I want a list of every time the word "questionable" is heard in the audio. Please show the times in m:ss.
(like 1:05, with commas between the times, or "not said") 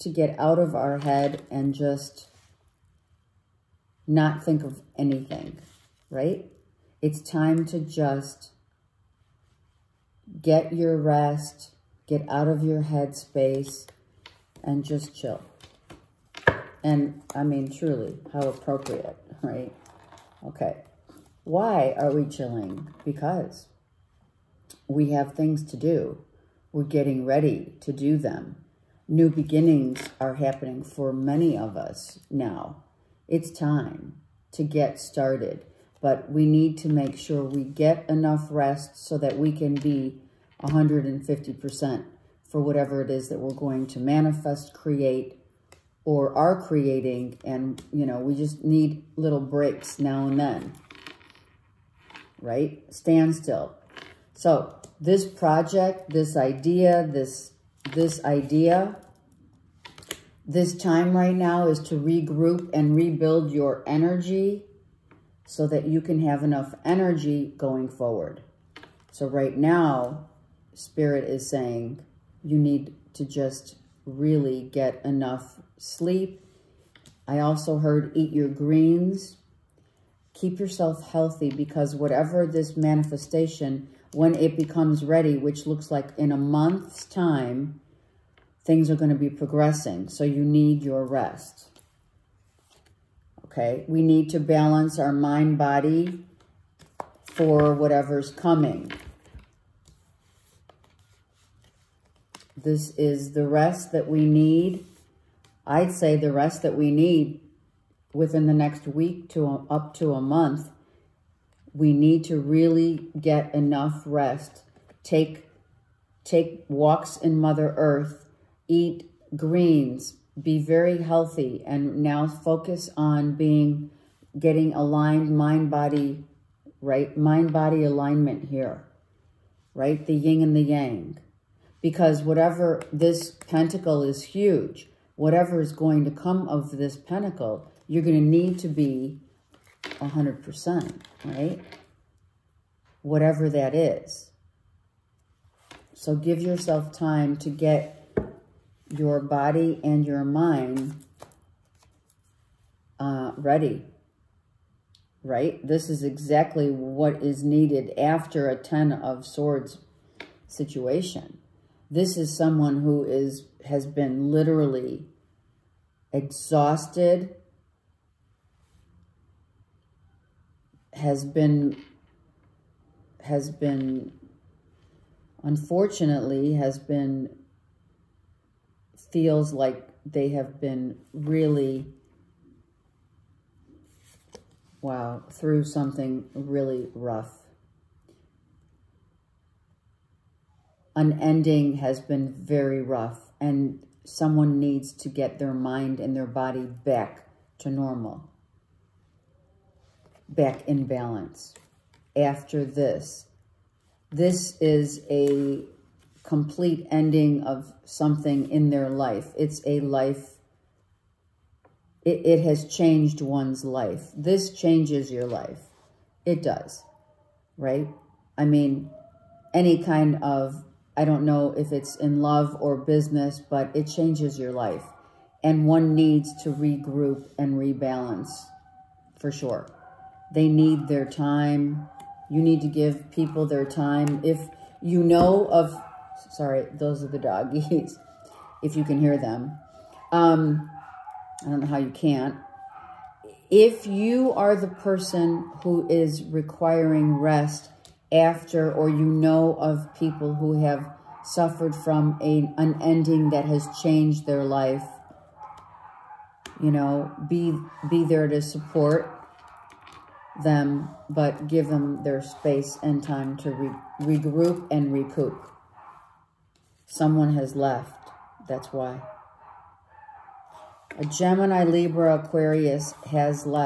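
not said.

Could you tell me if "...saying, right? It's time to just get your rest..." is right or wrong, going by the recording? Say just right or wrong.
wrong.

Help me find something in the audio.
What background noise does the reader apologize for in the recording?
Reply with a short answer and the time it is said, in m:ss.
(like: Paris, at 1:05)
the doggies, at 3:57.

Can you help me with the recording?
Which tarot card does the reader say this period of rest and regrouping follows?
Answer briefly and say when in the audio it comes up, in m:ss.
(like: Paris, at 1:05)
10 of swords, at 2:38.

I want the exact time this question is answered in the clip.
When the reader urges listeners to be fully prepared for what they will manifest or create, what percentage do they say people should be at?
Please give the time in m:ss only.
0:40.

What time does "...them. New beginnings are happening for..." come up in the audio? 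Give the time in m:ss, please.
0:28.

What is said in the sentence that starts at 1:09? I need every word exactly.
So right now, spirit is saying you need to just really get enough sleep.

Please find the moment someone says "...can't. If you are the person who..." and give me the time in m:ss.
4:01.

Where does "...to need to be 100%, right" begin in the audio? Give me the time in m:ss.
2:18.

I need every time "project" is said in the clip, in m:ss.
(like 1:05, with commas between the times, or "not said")
0:55.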